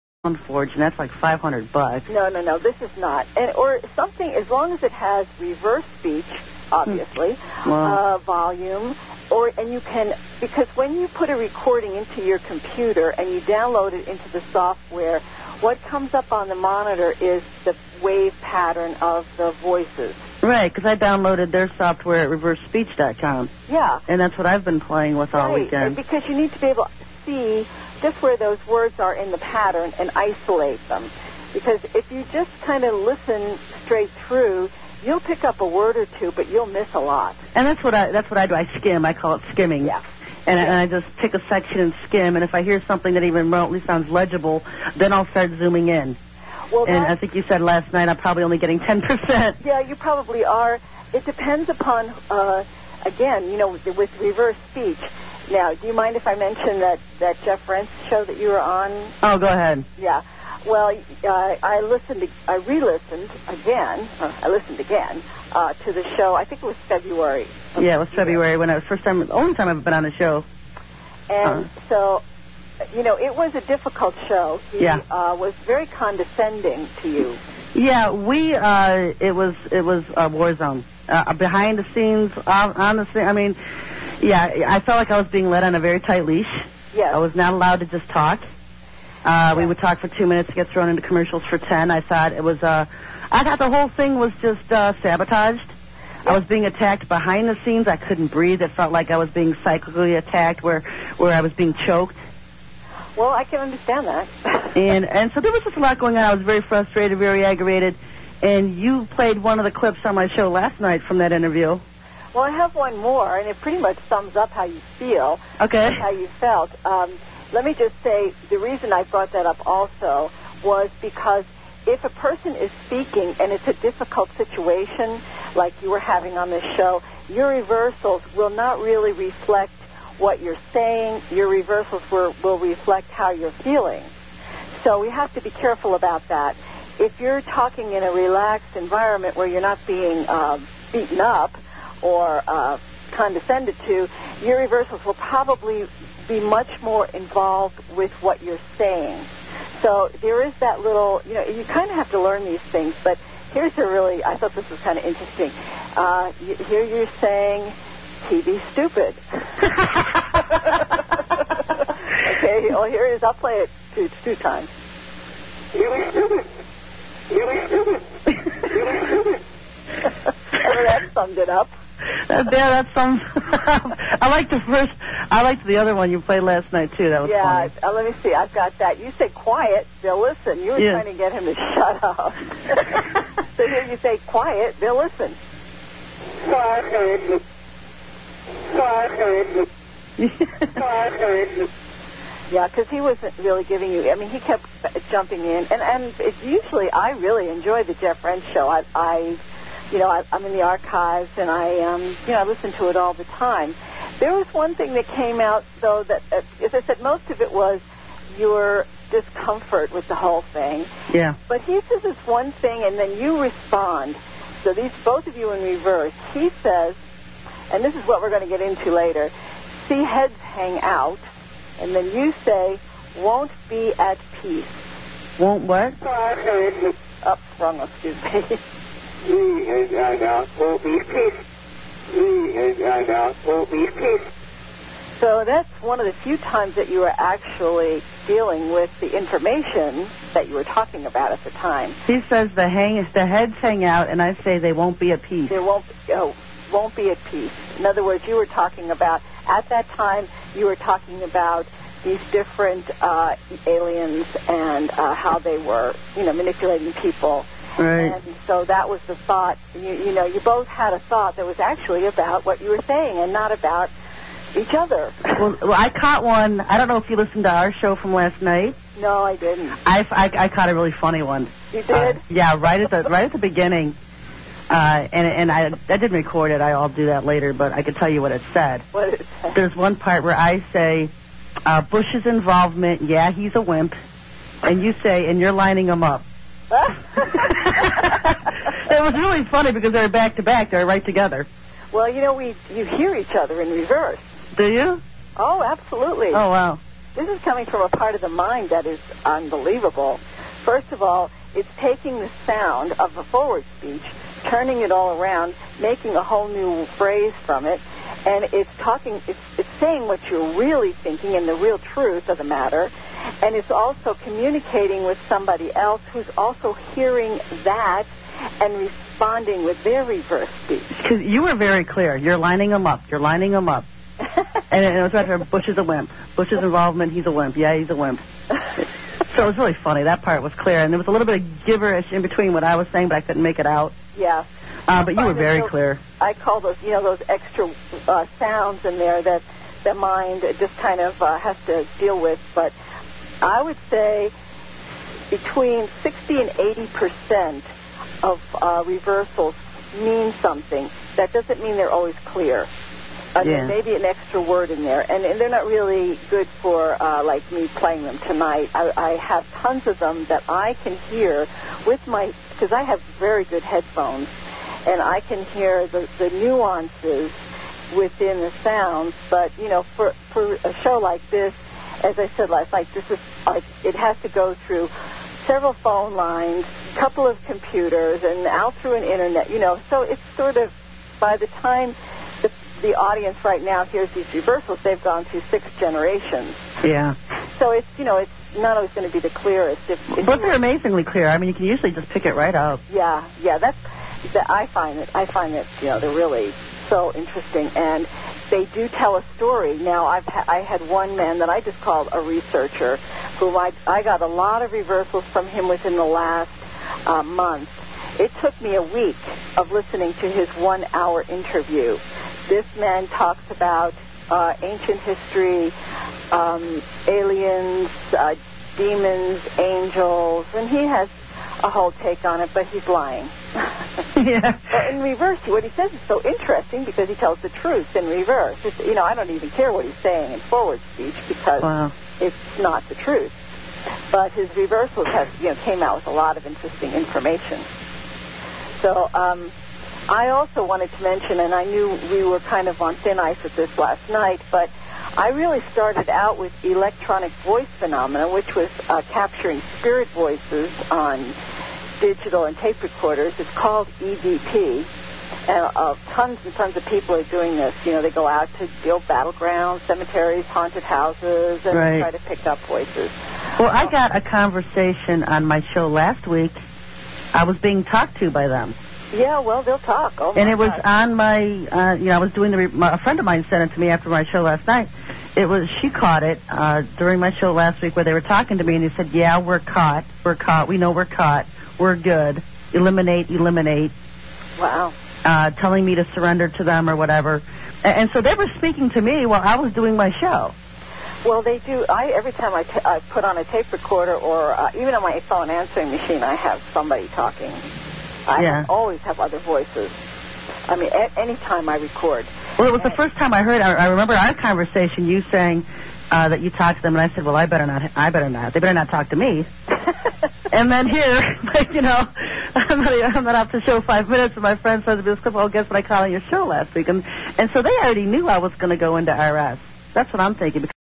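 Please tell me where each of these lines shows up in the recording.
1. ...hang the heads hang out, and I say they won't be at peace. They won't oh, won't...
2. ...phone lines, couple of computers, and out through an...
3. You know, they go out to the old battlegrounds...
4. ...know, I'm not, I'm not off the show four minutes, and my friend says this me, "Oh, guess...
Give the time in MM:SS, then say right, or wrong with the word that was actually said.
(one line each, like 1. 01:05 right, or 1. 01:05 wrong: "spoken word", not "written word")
1. 04:02 right
2. 06:15 right
3. 07:37 right
4. 08:31 wrong: "five", not "four".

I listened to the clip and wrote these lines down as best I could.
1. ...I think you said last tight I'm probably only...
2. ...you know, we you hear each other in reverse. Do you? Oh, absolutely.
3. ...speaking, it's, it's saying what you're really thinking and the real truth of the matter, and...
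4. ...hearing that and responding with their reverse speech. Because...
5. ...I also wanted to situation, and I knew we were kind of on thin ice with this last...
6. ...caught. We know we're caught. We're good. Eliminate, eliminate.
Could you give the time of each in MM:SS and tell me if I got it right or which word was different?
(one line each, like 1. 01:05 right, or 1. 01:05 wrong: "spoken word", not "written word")
1. 00:47 wrong: "night", not "tight"
2. 04:52 right
3. 05:08 wrong: "talking", not "speaking"
4. 05:16 right
5. 07:20 wrong: "mention", not "situation"
6. 08:00 right.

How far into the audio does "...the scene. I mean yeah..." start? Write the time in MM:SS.
01:22.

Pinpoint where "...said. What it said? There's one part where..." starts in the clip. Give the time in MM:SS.
04:38.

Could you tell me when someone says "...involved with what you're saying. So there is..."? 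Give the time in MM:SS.
02:27.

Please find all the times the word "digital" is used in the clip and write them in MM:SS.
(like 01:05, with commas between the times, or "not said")
07:31.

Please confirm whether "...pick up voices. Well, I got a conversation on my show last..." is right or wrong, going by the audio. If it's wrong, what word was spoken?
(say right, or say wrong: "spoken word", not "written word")
right.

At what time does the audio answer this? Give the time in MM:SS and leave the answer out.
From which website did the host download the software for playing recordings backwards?
00:22.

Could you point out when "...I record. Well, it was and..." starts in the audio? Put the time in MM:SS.
08:21.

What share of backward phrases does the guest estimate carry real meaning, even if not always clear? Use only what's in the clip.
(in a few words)
60 to 80 percent.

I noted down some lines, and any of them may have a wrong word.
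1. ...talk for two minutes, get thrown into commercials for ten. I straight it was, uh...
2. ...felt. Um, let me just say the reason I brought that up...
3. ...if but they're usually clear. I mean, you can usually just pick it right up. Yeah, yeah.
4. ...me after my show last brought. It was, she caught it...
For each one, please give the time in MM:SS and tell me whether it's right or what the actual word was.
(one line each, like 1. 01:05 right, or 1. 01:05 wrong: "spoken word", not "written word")
1. 01:29 wrong: "thought", not "straight"
2. 01:56 right
3. 06:30 wrong: "amazingly", not "usually"
4. 07:53 wrong: "night", not "brought".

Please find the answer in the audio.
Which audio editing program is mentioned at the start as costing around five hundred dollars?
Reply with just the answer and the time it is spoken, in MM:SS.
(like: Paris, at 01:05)
Sound Forge, at 00:00.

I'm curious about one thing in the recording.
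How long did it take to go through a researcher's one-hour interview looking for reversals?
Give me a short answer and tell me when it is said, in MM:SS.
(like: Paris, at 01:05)
a week, at 06:48.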